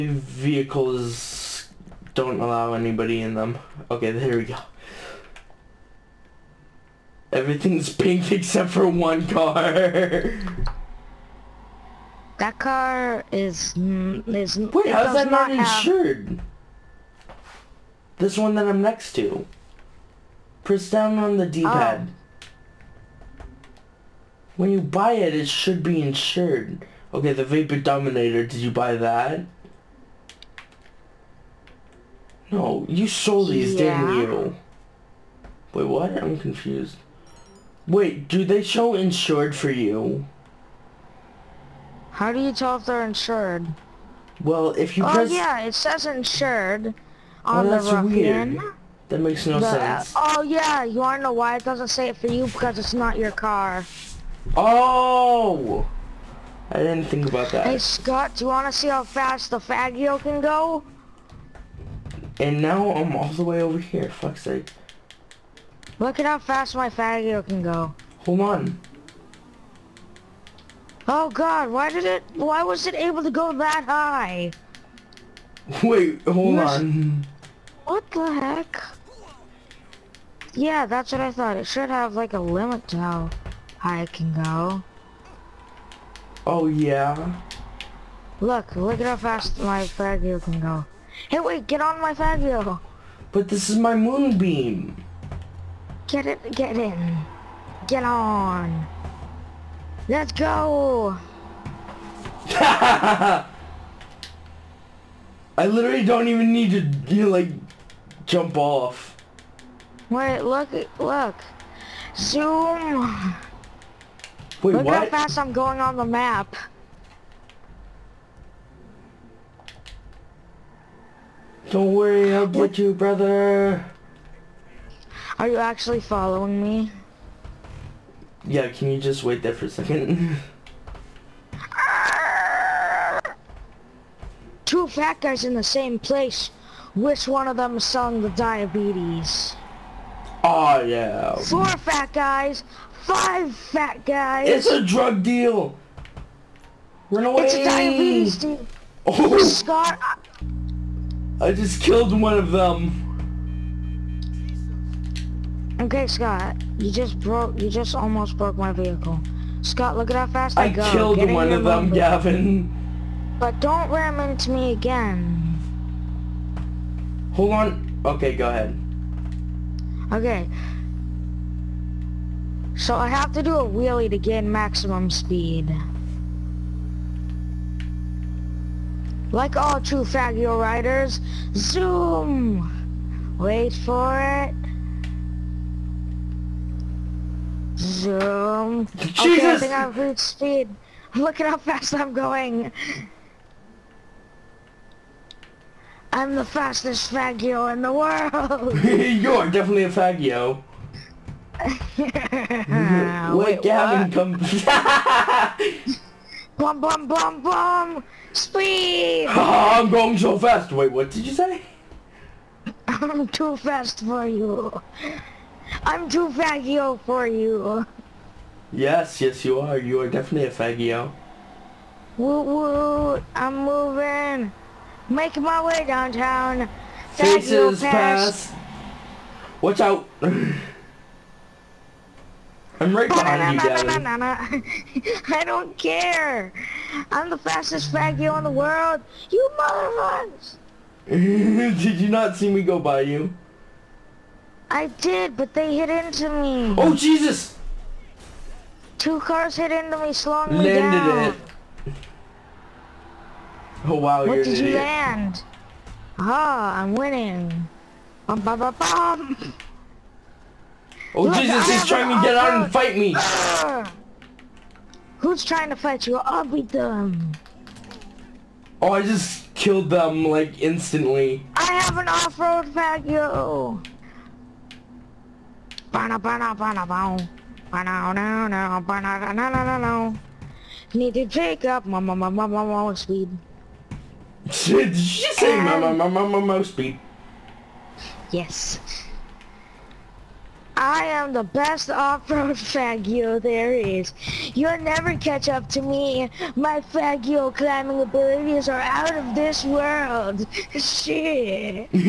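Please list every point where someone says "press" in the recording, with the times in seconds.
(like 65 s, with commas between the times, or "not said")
20 s, 45 s.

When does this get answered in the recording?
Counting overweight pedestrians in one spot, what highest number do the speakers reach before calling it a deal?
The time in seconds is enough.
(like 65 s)
143 s.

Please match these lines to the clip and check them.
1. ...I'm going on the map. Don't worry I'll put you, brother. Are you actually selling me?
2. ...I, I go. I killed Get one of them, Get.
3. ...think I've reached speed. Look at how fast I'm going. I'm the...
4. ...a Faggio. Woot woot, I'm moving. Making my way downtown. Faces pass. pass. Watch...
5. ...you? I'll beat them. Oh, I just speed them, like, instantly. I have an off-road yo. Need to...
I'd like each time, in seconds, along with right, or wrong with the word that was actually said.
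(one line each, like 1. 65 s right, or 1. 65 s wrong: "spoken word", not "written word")
1. 115 s wrong: "following", not "selling"
2. 160 s wrong: "Gavin", not "Get"
3. 189 s right
4. 220 s right
5. 266 s wrong: "killed", not "speed".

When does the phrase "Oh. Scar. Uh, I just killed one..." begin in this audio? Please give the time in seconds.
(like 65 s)
149 s.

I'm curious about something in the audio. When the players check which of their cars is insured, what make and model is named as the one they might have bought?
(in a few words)
Vapid Dominator.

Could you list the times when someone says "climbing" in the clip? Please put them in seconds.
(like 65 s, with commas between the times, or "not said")
297 s.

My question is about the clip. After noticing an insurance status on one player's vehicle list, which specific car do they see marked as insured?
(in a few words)
Ruffian.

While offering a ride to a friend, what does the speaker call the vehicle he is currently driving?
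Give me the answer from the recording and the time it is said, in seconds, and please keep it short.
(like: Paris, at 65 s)
Moonbeam, at 93 s.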